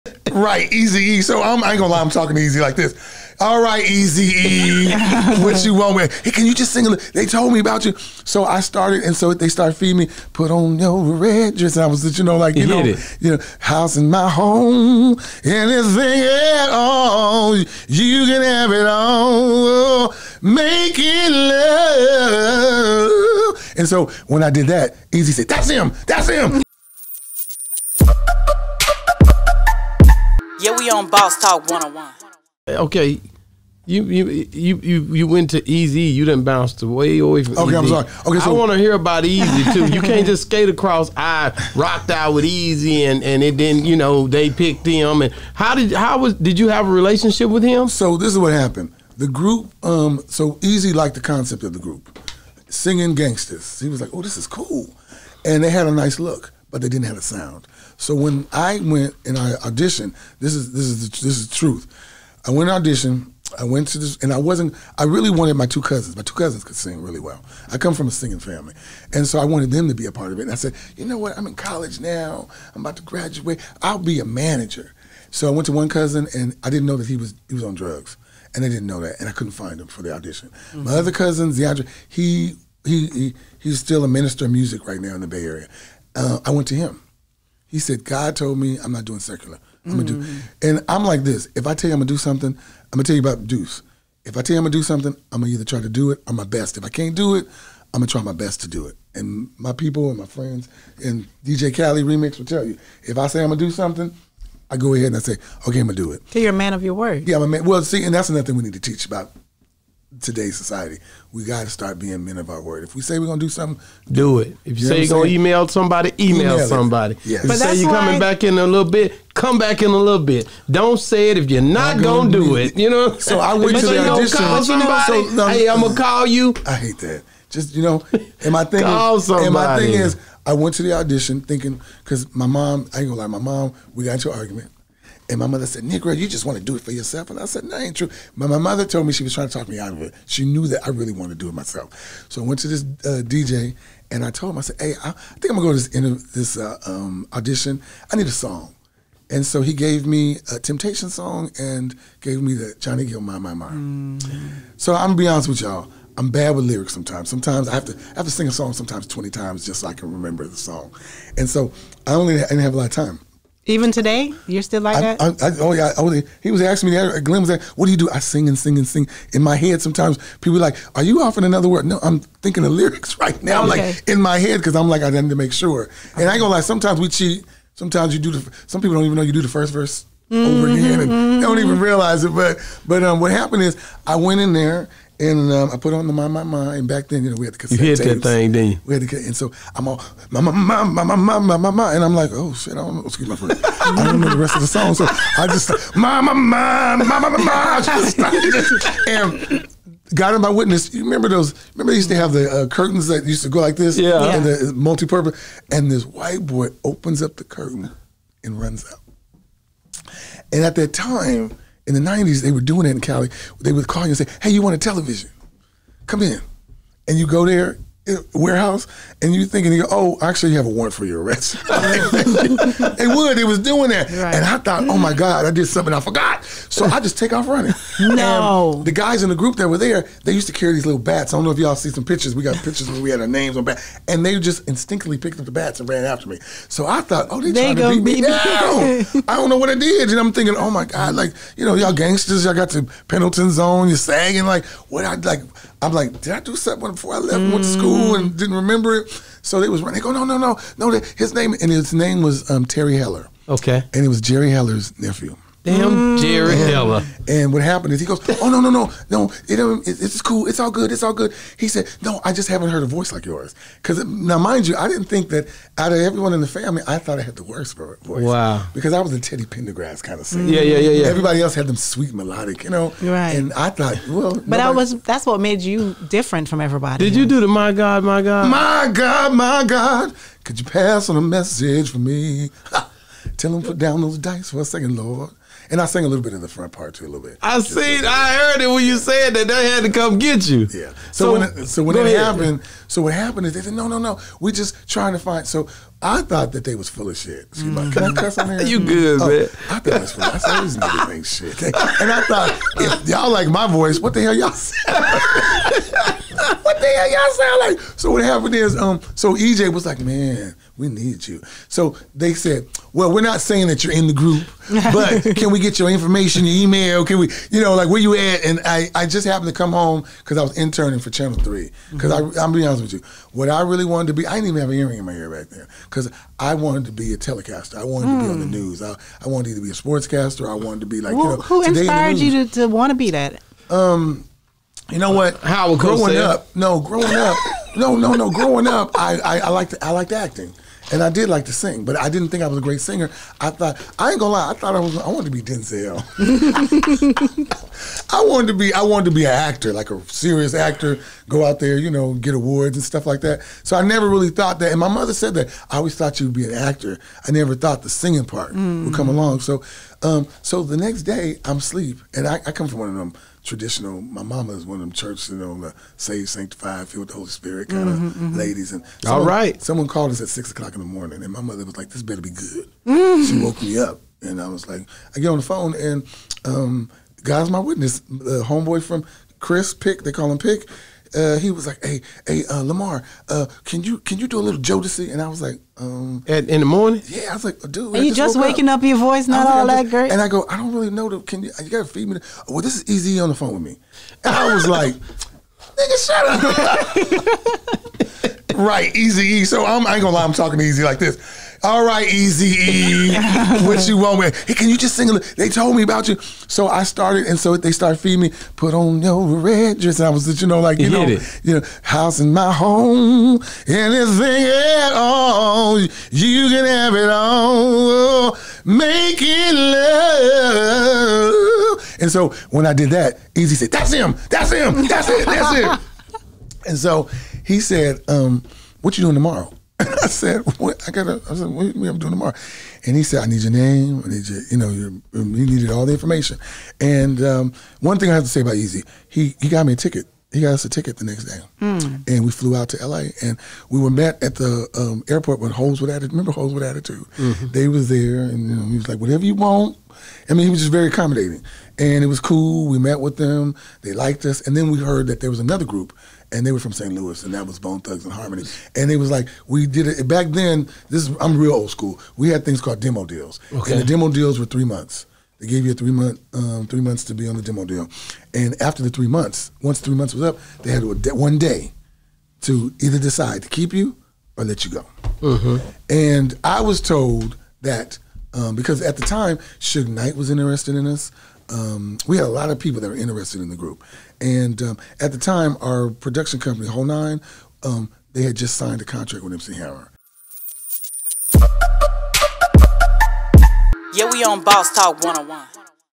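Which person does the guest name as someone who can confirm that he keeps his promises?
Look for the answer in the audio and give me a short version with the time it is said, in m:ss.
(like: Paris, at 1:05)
DJ Cali Remix, at 1:41.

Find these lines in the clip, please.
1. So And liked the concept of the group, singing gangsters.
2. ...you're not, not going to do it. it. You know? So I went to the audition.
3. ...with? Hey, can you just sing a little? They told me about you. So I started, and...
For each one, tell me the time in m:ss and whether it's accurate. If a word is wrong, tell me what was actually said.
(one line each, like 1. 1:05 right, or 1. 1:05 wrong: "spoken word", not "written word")
1. 0:50 wrong: "Eazy", not "And"
2. 2:01 right
3. 6:44 right.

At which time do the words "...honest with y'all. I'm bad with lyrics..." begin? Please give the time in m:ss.
2:35.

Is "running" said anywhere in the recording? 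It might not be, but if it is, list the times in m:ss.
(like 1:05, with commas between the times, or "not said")
3:47, 4:09.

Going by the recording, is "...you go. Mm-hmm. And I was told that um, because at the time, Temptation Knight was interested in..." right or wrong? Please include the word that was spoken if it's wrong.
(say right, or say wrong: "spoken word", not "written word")
wrong: "Suge", not "Temptation".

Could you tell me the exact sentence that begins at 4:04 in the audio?
Like, what I, like, I'm like, did I do something before I left mm.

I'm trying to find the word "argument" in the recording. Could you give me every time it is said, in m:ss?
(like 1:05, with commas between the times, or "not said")
2:14.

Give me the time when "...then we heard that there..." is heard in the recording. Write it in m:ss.
7:34.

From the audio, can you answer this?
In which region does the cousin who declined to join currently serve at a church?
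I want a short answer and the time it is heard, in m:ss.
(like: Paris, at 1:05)
Bay Area, at 1:25.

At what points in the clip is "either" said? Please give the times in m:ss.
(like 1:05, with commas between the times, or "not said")
1:35, 7:52.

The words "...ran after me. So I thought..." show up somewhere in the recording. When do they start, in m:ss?
3:55.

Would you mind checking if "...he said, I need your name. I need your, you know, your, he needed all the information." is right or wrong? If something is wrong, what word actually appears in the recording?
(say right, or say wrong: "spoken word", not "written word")
right.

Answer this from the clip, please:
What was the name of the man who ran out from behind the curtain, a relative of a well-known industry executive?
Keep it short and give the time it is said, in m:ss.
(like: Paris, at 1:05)
Terry Heller, at 4:12.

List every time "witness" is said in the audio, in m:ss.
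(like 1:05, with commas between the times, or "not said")
3:20, 6:17.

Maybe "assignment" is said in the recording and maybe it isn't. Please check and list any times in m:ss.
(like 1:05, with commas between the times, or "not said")
not said.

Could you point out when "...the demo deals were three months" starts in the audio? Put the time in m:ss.
7:43.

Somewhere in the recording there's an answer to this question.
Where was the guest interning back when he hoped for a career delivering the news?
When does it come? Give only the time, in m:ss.
5:21.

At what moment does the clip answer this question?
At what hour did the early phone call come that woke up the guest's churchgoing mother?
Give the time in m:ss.
6:10.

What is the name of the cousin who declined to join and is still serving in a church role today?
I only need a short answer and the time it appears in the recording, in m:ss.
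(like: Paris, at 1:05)
DeAndre, at 1:21.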